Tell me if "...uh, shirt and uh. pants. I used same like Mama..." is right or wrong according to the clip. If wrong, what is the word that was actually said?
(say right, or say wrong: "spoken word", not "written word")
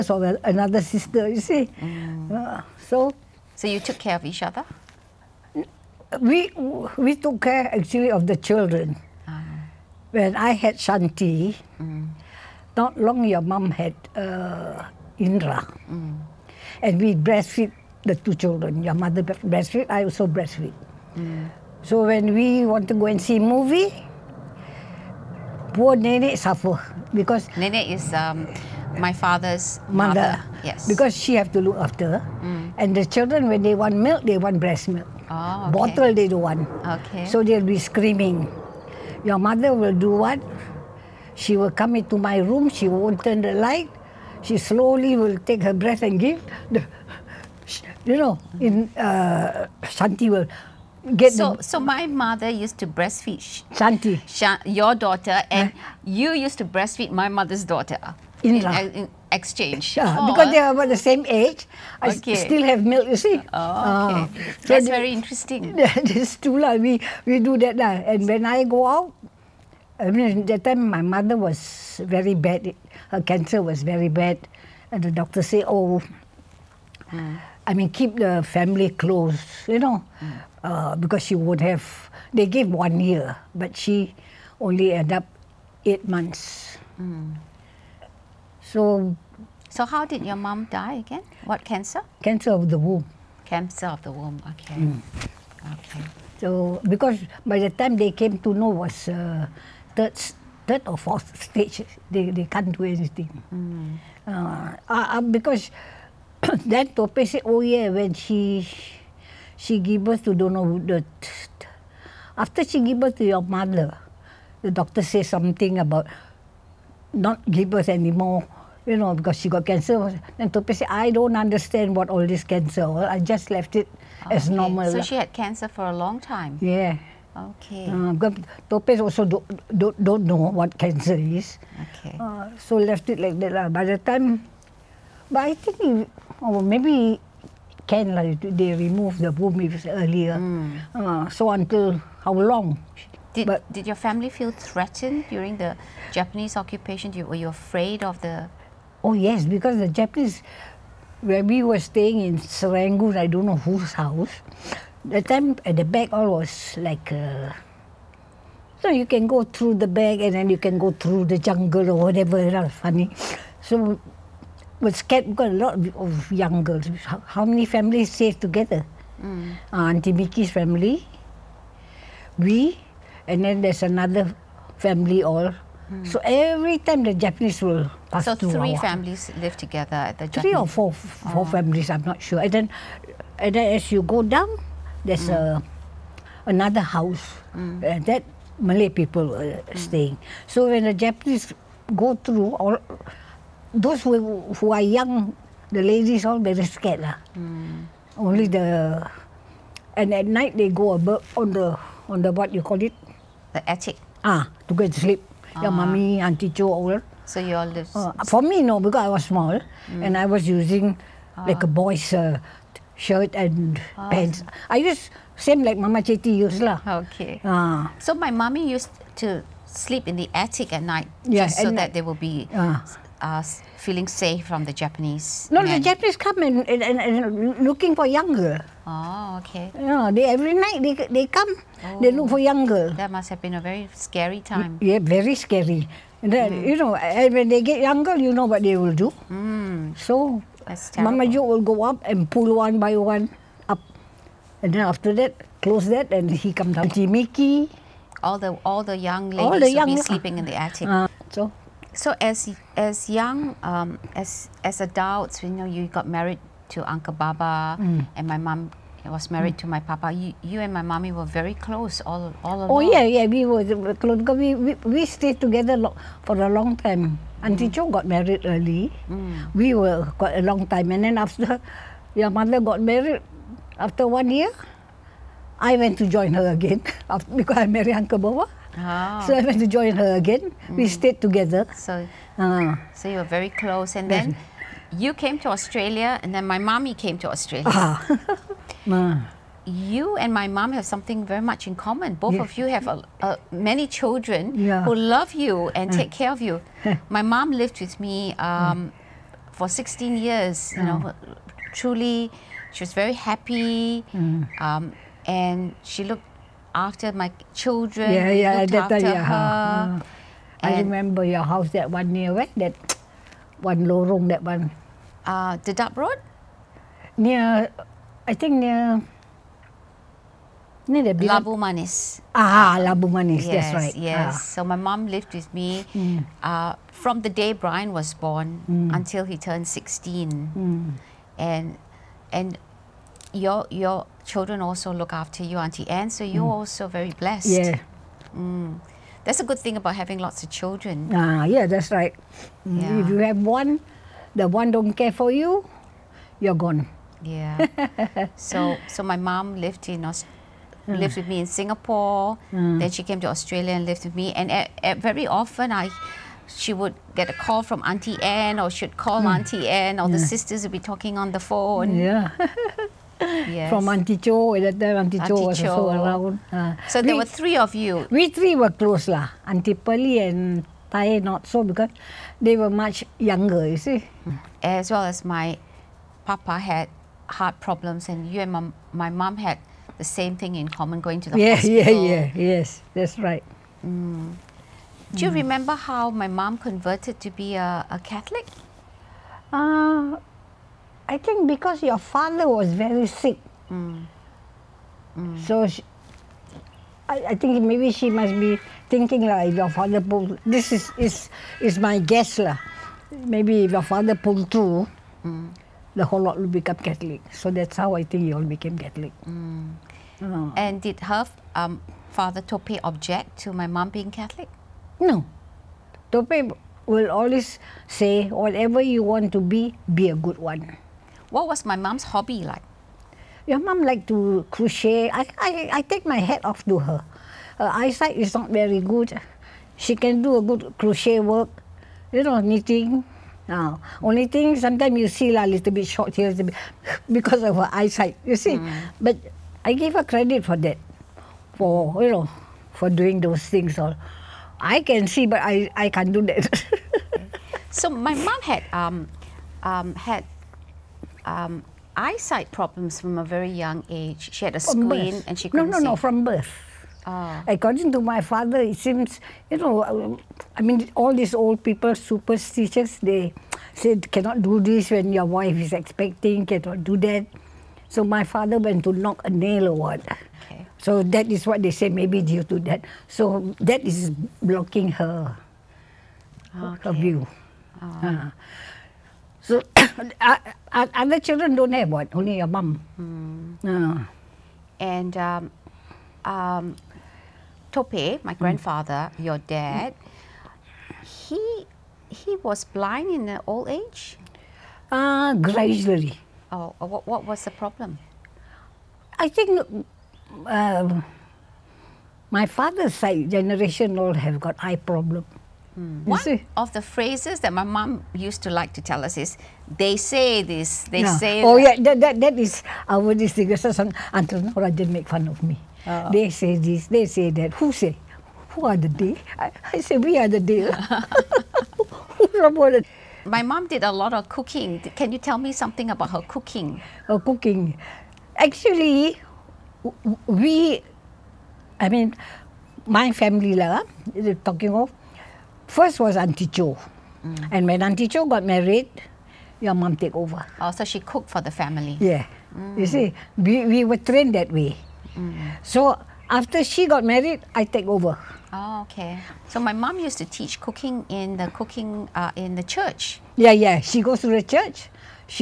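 right.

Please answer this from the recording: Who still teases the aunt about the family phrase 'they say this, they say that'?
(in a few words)
Rajan.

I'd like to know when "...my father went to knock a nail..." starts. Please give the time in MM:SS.
07:48.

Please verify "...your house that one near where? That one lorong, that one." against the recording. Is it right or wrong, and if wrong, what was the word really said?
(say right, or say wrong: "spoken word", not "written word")
right.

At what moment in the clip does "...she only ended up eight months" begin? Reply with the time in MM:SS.
01:23.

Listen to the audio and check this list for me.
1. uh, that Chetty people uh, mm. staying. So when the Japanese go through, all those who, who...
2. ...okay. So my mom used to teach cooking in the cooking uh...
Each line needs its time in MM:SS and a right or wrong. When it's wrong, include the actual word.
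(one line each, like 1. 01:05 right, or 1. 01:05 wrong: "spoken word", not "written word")
1. 03:07 wrong: "Malay", not "Chetty"
2. 09:08 right.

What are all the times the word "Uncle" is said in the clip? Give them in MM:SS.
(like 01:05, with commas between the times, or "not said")
04:16, 04:37.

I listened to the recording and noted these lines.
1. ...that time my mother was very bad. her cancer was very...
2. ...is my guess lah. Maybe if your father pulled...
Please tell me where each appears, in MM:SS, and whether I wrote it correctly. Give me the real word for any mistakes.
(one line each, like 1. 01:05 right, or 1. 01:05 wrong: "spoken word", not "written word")
1. 01:10 right
2. 06:41 right.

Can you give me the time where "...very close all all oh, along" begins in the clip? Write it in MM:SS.
04:21.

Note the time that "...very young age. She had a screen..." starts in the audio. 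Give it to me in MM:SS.
07:33.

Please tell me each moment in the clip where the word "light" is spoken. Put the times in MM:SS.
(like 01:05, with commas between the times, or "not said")
00:43.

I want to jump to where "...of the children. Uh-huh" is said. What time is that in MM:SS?
00:08.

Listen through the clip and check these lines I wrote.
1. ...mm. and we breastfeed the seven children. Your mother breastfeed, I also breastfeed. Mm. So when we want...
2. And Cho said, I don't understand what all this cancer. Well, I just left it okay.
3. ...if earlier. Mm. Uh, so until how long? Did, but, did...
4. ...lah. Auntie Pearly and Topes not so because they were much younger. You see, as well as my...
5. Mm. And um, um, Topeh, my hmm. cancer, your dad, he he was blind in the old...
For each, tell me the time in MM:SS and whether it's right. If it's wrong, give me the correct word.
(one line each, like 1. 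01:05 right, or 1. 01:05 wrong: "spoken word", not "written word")
1. 00:15 wrong: "two", not "seven"
2. 02:00 wrong: "Topeh", not "Cho"
3. 02:19 right
4. 06:09 wrong: "Tai", not "Topes"
5. 08:02 wrong: "grandfather", not "cancer".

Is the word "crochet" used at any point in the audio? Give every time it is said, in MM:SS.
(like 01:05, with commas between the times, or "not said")
07:04, 07:10.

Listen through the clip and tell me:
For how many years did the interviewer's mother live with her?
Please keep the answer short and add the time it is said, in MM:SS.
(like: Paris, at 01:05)
16, at 04:59.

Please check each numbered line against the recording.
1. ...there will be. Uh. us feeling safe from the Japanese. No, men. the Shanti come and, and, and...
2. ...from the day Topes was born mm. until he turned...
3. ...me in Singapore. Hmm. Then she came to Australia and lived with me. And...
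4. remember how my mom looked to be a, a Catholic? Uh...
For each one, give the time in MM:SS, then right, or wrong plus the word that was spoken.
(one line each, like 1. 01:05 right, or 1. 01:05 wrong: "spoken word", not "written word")
1. 03:41 wrong: "Japanese", not "Shanti"
2. 05:26 wrong: "Brian", not "Topes"
3. 05:51 right
4. 06:25 wrong: "converted", not "looked".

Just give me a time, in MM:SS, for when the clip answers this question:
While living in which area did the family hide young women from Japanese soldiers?
02:32.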